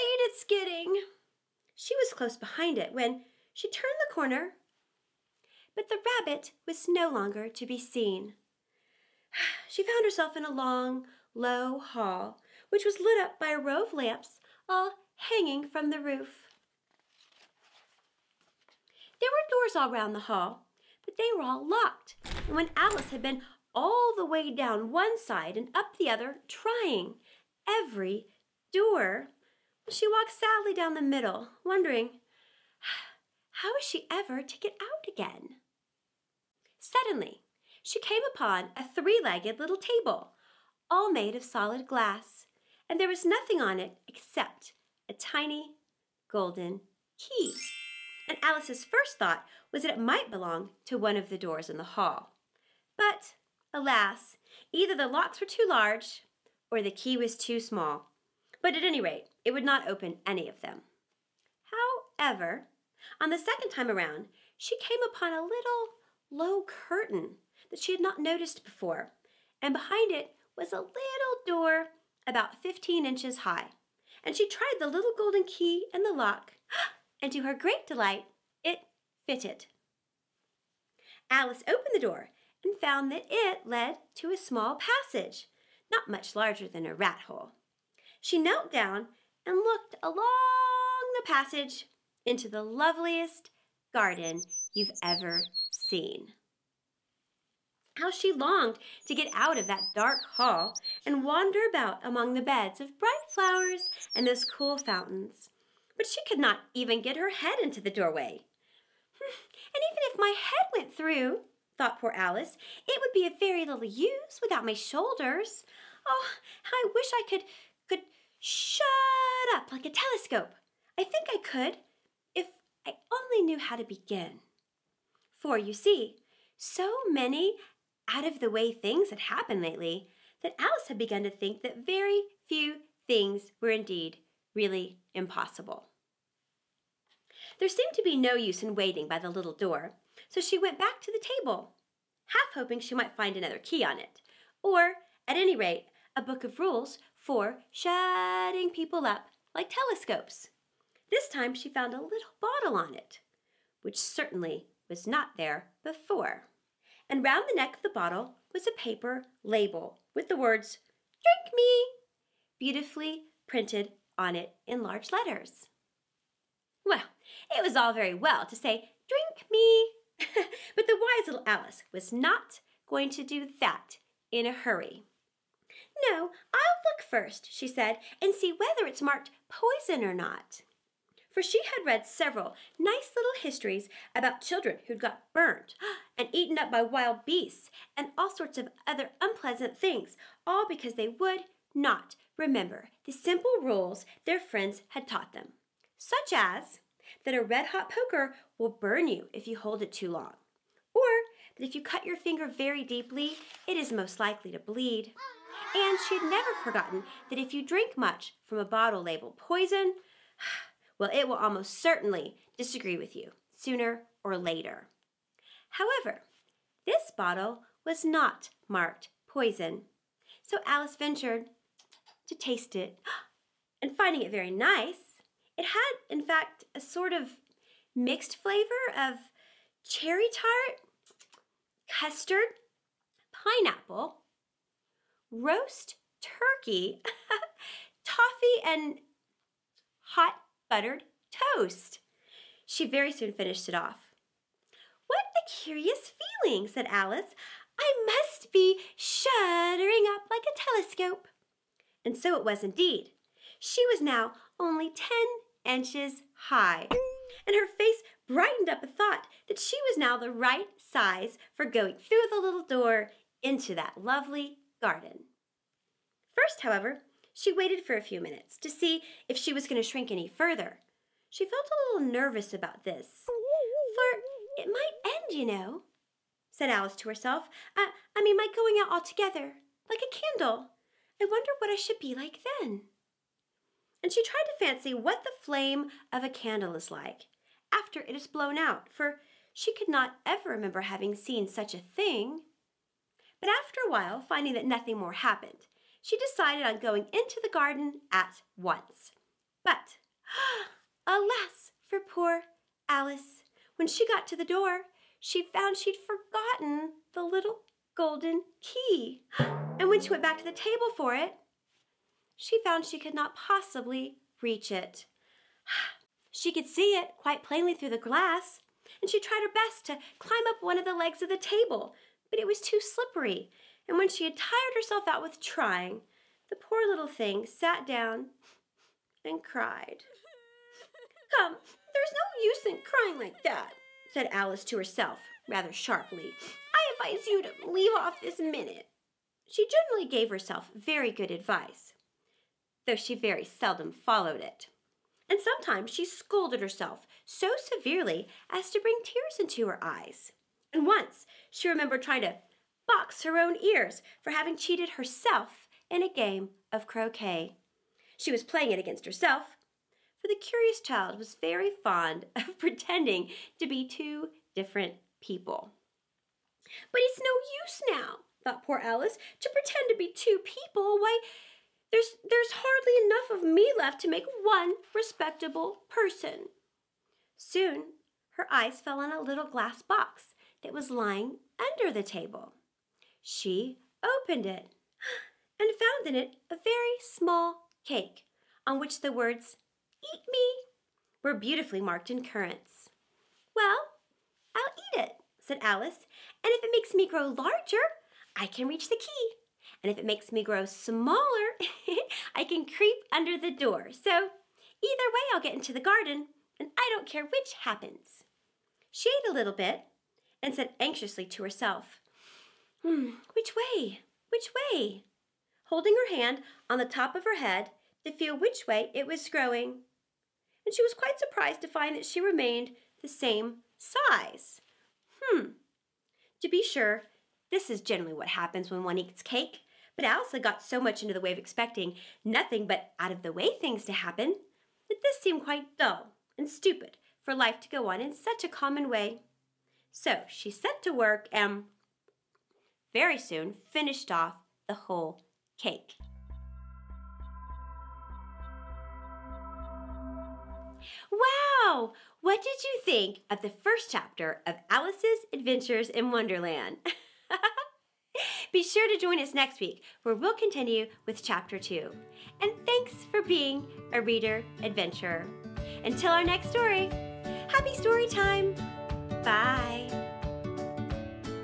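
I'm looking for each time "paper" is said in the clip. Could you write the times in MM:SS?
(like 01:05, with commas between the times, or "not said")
02:38.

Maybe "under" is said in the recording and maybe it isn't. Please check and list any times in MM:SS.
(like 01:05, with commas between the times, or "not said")
06:21, 06:43.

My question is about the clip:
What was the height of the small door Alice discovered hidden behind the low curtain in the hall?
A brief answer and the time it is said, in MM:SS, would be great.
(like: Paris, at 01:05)
15 inches, at 01:12.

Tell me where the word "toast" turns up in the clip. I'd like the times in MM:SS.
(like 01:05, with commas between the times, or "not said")
04:01.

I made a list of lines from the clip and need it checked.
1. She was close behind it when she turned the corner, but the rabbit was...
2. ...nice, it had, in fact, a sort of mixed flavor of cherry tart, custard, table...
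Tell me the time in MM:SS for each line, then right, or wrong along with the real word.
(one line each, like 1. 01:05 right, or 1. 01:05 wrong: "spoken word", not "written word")
1. 00:01 right
2. 03:44 wrong: "pineapple", not "table".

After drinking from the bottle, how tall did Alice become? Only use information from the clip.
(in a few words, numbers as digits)
10 inches.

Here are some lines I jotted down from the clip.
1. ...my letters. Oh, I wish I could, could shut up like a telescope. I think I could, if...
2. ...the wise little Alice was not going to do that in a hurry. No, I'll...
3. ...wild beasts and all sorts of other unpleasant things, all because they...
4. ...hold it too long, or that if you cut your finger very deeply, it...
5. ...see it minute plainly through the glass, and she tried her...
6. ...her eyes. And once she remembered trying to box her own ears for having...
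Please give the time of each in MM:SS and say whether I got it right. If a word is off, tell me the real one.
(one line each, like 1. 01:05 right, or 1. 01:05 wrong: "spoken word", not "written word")
1. 01:54 wrong: "shoulders", not "letters"
2. 02:50 right
3. 03:06 right
4. 03:19 right
5. 05:16 wrong: "quite", not "minute"
6. 05:49 right.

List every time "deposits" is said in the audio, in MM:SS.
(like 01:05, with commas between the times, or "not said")
not said.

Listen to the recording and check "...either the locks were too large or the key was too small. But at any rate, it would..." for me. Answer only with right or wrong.
right.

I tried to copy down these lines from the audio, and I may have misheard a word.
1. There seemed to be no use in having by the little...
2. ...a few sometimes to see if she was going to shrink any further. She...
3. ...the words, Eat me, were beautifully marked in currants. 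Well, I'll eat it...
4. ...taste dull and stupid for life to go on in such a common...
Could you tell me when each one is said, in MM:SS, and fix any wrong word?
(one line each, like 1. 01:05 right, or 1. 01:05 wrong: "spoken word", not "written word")
1. 02:17 wrong: "waiting", not "having"
2. 04:27 wrong: "minutes", not "sometimes"
3. 06:29 right
4. 07:15 wrong: "quite", not "taste".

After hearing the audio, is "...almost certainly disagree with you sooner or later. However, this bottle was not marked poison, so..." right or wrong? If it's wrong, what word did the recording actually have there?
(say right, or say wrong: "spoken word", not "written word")
right.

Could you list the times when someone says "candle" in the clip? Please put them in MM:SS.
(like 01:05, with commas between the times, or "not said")
04:40, 04:46.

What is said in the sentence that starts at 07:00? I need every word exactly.
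And she was quite surprised to find that she remained the same size.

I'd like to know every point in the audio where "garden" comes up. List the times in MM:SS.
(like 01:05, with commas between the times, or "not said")
01:33, 04:24, 04:57, 06:45.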